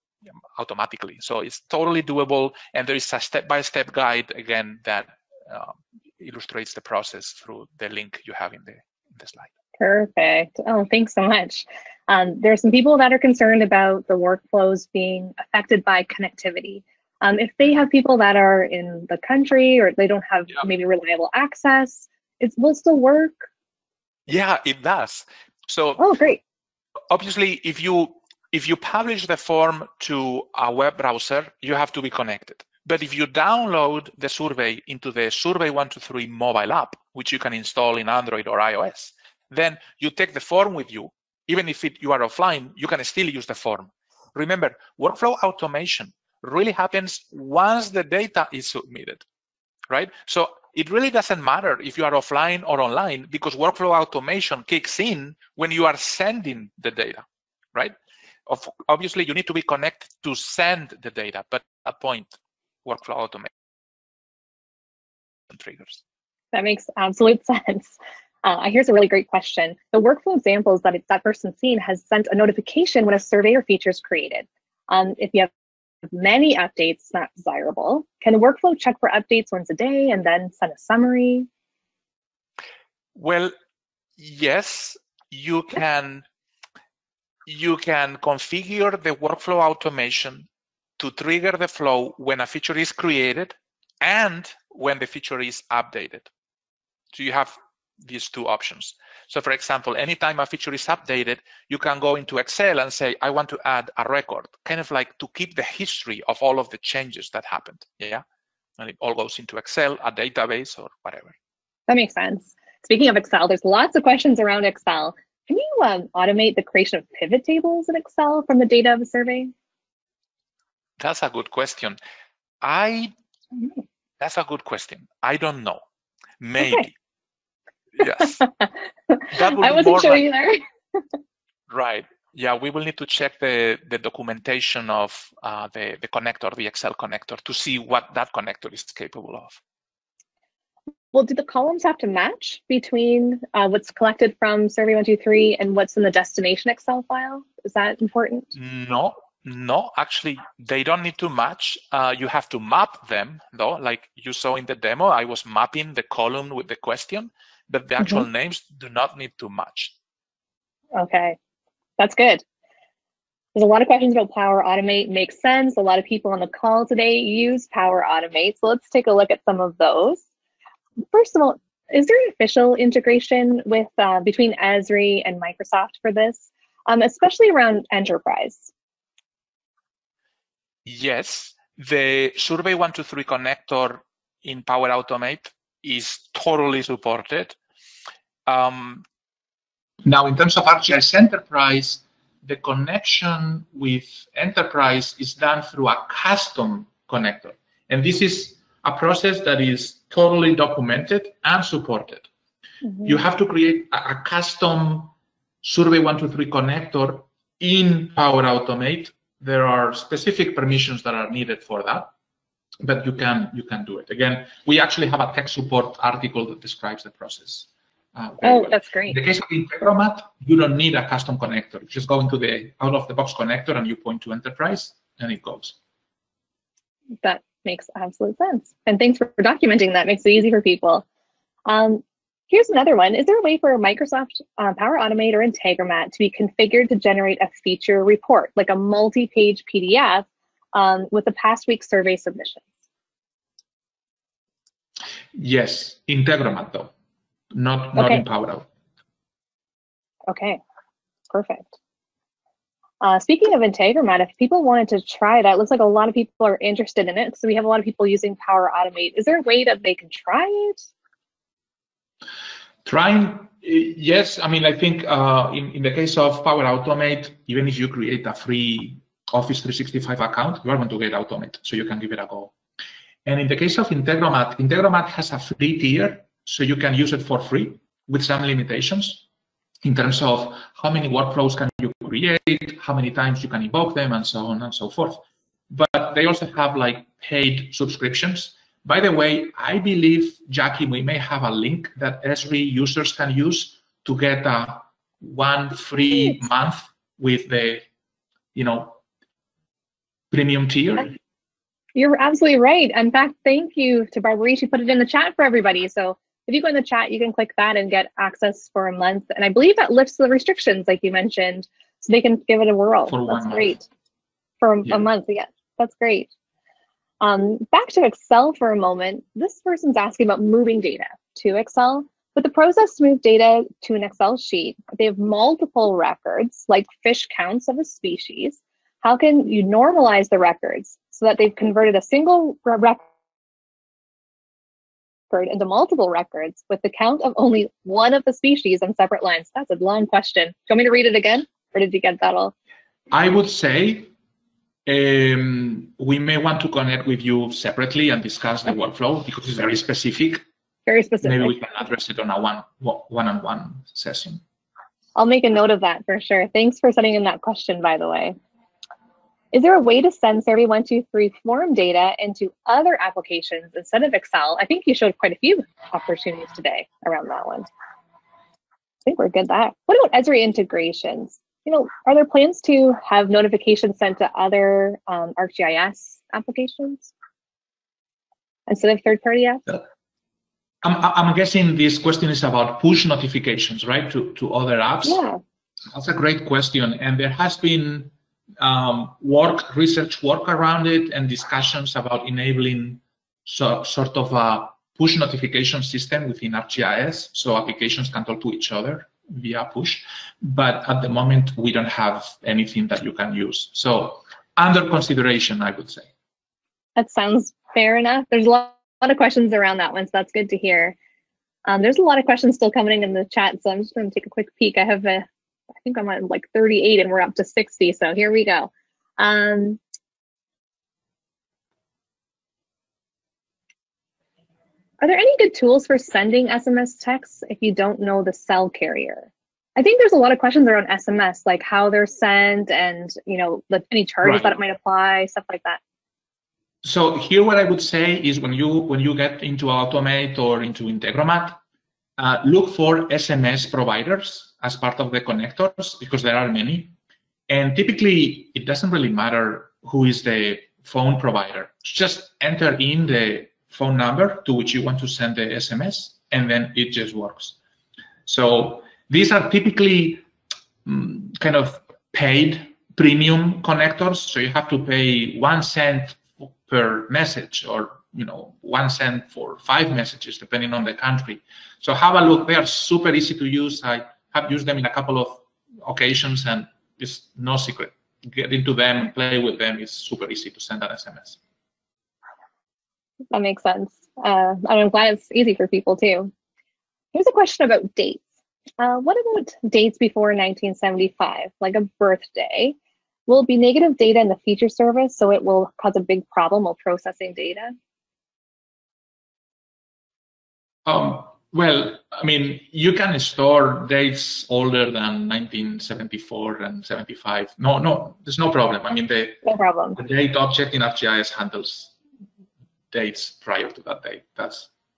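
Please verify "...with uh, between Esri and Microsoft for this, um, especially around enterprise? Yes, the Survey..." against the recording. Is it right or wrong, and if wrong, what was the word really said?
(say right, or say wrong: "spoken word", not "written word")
right.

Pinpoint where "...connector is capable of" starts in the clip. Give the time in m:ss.
2:18.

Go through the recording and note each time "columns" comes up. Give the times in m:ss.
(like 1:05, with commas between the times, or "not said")
2:21, 2:36.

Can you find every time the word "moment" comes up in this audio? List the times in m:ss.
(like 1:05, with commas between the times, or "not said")
5:18, 6:41.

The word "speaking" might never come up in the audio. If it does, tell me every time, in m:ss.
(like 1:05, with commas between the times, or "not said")
1:52, 4:13.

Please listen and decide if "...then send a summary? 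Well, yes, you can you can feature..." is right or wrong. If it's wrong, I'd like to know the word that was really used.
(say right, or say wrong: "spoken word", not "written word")
wrong: "configure", not "feature".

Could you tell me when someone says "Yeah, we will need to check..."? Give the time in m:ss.
2:12.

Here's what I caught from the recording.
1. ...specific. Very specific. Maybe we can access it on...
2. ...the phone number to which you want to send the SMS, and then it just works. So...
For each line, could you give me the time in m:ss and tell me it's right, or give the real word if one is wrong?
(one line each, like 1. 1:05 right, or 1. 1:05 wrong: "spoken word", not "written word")
1. 5:49 wrong: "address", not "access"
2. 7:33 right.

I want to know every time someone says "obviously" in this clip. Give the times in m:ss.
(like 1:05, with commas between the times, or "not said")
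0:27, 0:58.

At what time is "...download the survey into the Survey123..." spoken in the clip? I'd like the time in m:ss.
0:33.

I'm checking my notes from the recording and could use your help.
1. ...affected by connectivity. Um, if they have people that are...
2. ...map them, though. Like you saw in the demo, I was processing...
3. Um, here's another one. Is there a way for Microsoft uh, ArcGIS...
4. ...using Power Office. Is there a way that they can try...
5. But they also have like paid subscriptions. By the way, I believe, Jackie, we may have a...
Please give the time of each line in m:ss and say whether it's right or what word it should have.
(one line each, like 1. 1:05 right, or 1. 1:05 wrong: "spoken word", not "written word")
1. 0:15 right
2. 2:32 wrong: "mapping", not "processing"
3. 3:51 wrong: "Power", not "ArcGIS"
4. 4:18 wrong: "Automate", not "Office"
5. 4:45 right.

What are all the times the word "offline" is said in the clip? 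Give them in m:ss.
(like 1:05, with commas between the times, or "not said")
0:42, 0:52.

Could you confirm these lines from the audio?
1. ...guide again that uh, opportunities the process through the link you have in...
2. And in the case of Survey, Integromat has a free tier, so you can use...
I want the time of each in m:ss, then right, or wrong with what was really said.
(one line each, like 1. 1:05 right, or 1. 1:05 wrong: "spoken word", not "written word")
1. 0:03 wrong: "illustrates", not "opportunities"
2. 4:33 wrong: "Integromat", not "Survey".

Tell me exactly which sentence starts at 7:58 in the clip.
Get into them, and play with them.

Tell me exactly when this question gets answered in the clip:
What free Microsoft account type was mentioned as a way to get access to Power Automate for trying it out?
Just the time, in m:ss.
4:29.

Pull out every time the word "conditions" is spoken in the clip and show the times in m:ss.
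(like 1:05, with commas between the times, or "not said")
not said.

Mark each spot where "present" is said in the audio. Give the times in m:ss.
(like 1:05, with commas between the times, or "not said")
not said.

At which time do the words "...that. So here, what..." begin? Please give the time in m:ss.
7:15.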